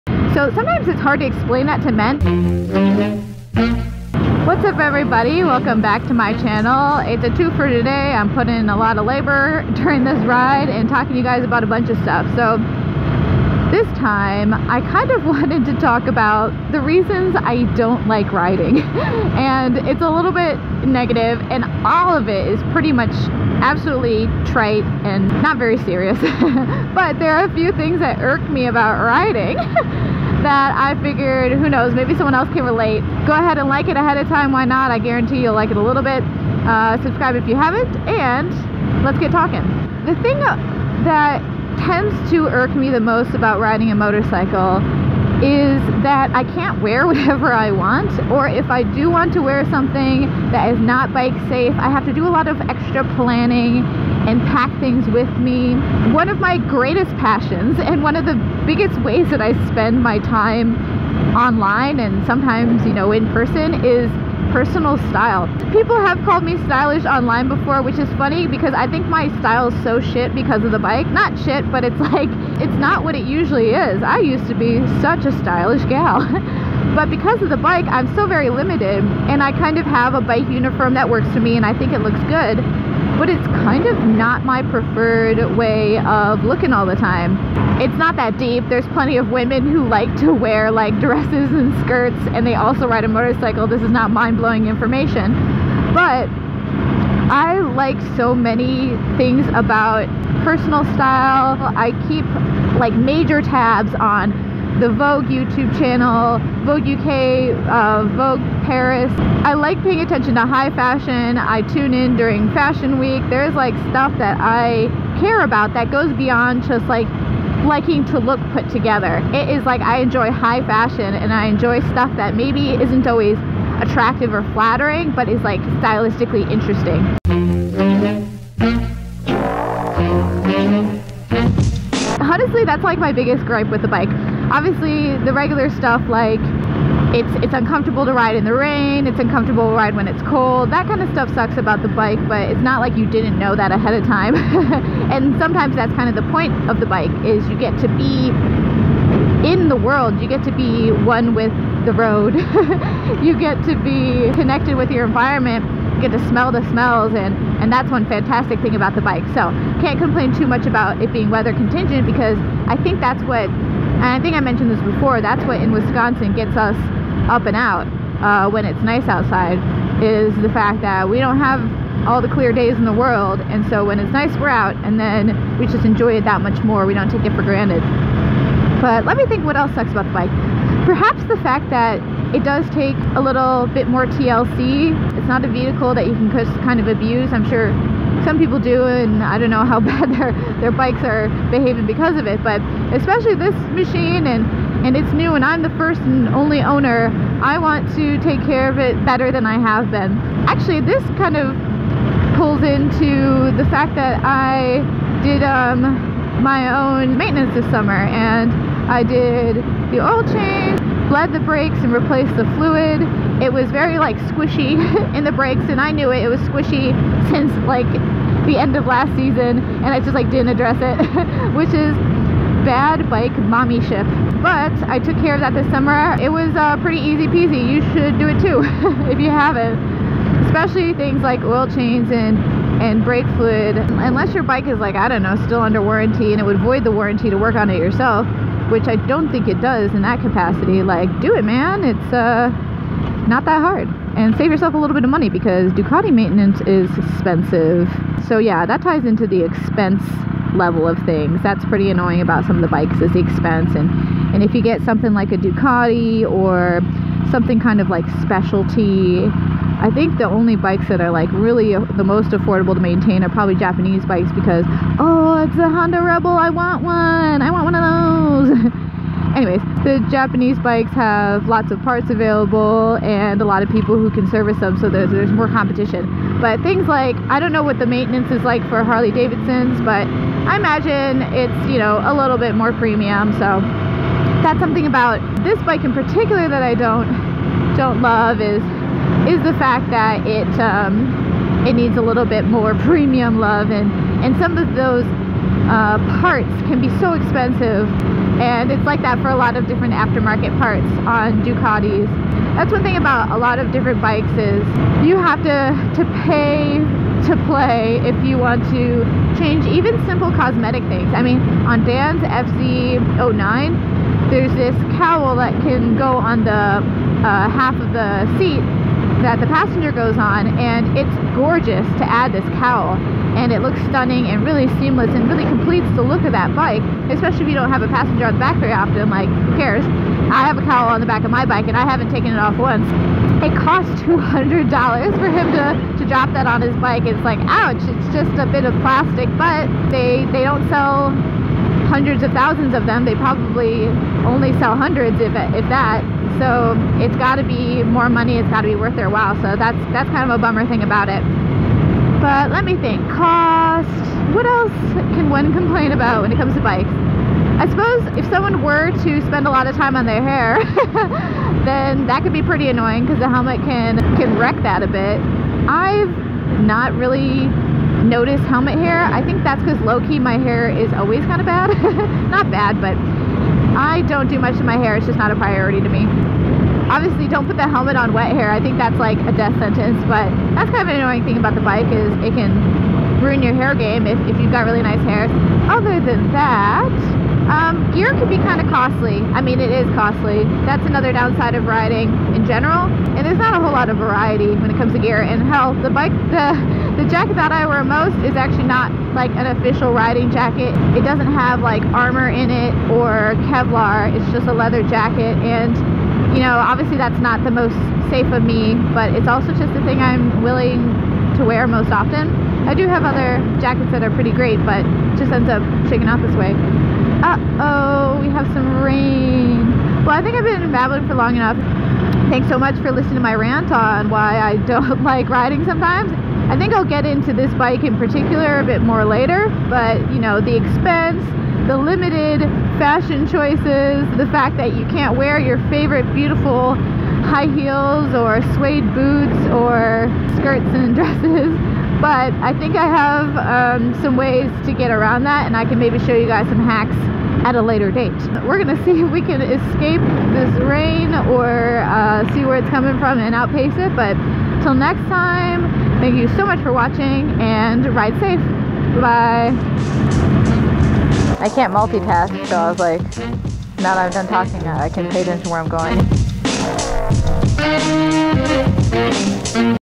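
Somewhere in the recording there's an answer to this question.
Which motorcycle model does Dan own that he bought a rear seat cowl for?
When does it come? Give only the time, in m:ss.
5:12.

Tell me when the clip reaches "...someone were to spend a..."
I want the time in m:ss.
5:58.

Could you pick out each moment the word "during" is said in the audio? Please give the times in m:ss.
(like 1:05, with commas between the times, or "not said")
0:09, 1:52.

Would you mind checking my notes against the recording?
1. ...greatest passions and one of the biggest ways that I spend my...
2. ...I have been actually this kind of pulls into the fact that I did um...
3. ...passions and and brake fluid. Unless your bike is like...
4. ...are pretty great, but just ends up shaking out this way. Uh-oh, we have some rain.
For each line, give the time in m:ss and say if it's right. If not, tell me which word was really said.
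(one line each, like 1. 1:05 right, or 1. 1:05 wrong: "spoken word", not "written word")
1. 0:56 right
2. 3:19 right
3. 3:51 wrong: "chains", not "passions"
4. 6:54 right.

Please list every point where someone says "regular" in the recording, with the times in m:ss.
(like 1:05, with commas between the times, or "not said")
2:15.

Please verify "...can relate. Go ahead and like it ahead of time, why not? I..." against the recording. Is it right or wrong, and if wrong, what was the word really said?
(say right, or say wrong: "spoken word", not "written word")
right.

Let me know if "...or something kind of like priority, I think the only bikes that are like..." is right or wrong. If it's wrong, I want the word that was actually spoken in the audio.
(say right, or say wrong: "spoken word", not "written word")
wrong: "specialty", not "priority".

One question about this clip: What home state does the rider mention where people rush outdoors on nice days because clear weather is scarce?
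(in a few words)
Wisconsin.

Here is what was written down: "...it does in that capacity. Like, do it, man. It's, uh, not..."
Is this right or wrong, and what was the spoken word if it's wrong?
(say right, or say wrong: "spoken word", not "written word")
right.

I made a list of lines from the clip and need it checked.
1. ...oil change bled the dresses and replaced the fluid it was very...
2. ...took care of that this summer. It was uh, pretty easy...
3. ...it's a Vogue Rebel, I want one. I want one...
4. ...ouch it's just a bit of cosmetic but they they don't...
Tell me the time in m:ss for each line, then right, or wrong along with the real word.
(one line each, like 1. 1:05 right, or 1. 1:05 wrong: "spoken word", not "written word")
1. 3:29 wrong: "brakes", not "dresses"
2. 3:44 right
3. 4:25 wrong: "Honda", not "Vogue"
4. 5:37 wrong: "plastic", not "cosmetic".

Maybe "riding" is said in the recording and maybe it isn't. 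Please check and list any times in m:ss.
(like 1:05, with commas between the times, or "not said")
0:18, 0:29, 0:43, 6:31, 6:39, 7:05.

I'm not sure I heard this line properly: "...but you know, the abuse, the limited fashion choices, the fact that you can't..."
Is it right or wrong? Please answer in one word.
wrong.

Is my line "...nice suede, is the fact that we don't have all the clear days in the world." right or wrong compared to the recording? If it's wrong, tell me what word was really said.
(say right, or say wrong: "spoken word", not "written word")
wrong: "outside", not "suede".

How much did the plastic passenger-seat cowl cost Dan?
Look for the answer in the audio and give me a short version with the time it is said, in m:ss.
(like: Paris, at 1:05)
$200, at 5:34.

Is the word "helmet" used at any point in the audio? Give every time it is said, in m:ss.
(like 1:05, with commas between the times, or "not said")
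6:03, 6:08, 6:17.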